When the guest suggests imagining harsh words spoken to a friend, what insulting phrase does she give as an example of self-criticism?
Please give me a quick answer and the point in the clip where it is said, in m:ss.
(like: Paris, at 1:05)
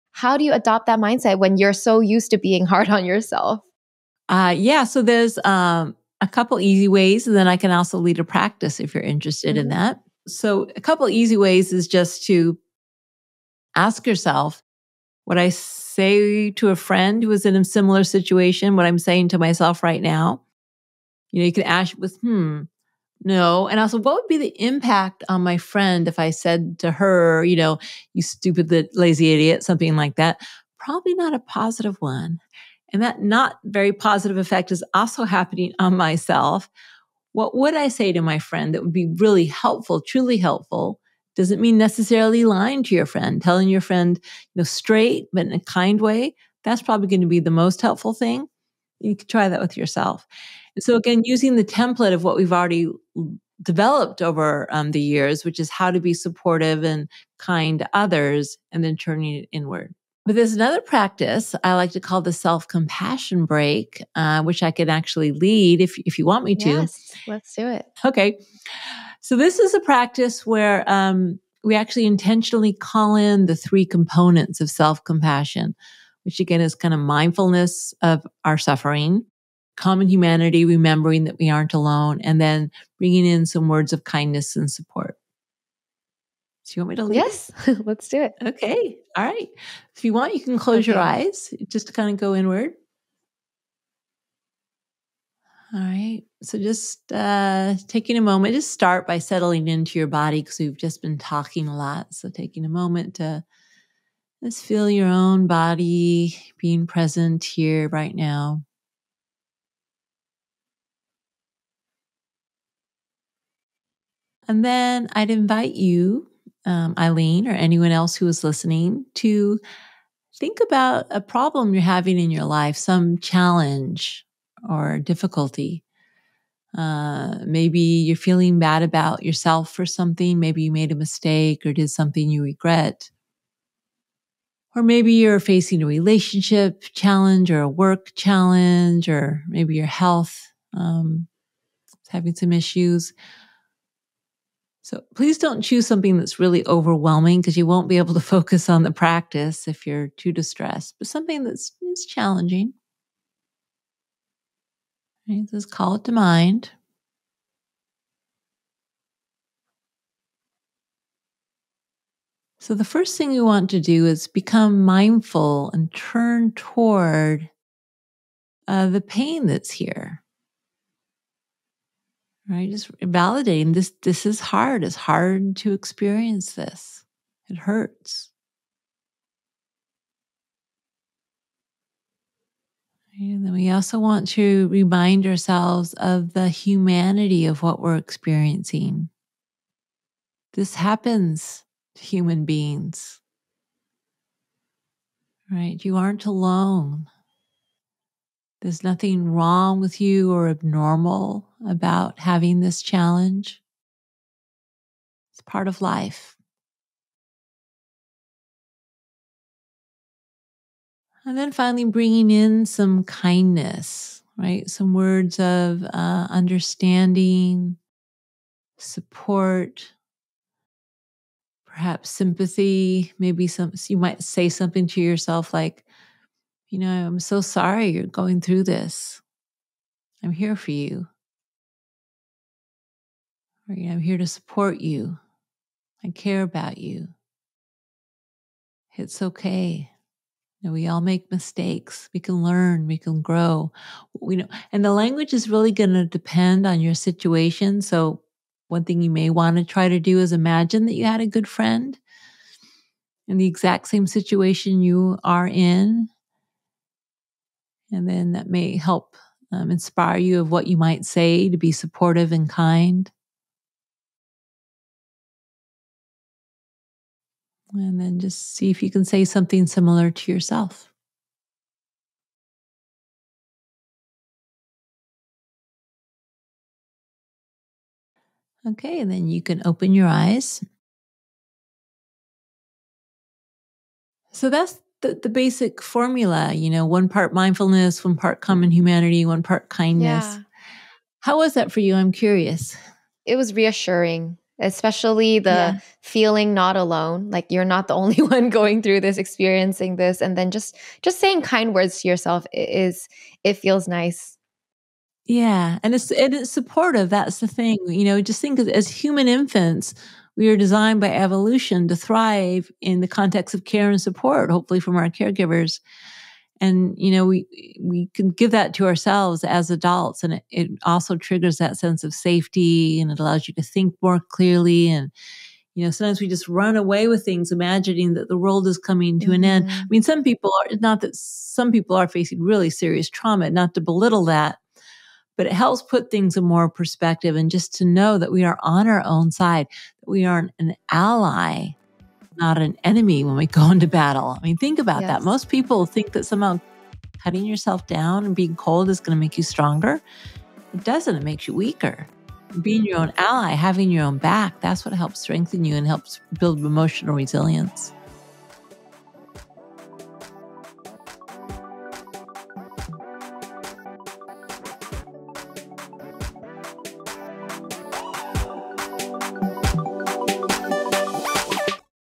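stupid lazy idiot, at 0:28.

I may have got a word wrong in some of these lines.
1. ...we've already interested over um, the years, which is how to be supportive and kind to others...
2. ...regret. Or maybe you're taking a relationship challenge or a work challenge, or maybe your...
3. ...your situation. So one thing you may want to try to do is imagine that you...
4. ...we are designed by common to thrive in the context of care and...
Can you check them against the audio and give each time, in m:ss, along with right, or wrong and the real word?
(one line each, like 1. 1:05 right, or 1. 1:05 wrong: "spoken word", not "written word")
1. 0:52 wrong: "developed", not "interested"
2. 2:12 wrong: "facing", not "taking"
3. 4:06 right
4. 5:10 wrong: "evolution", not "common".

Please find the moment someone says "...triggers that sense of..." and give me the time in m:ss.
5:21.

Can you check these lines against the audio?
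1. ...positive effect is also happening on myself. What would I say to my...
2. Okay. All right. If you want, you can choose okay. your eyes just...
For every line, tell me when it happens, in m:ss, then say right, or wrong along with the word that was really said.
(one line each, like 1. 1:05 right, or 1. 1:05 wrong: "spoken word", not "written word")
1. 0:33 right
2. 1:28 wrong: "close", not "choose".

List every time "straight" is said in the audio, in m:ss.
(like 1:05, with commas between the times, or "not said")
0:44.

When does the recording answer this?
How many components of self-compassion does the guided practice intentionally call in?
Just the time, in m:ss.
1:13.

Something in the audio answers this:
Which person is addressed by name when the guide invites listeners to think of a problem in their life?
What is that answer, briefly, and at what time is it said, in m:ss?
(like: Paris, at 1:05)
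Aileen, at 1:56.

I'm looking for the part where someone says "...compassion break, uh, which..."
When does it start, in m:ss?
1:02.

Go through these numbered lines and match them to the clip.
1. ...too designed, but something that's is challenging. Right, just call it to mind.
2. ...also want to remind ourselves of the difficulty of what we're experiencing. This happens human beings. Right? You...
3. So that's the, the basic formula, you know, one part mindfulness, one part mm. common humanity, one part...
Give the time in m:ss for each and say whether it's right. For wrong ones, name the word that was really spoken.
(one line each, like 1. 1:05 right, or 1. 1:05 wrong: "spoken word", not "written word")
1. 2:30 wrong: "distressed", not "designed"
2. 3:03 wrong: "humanity", not "difficulty"
3. 4:44 right.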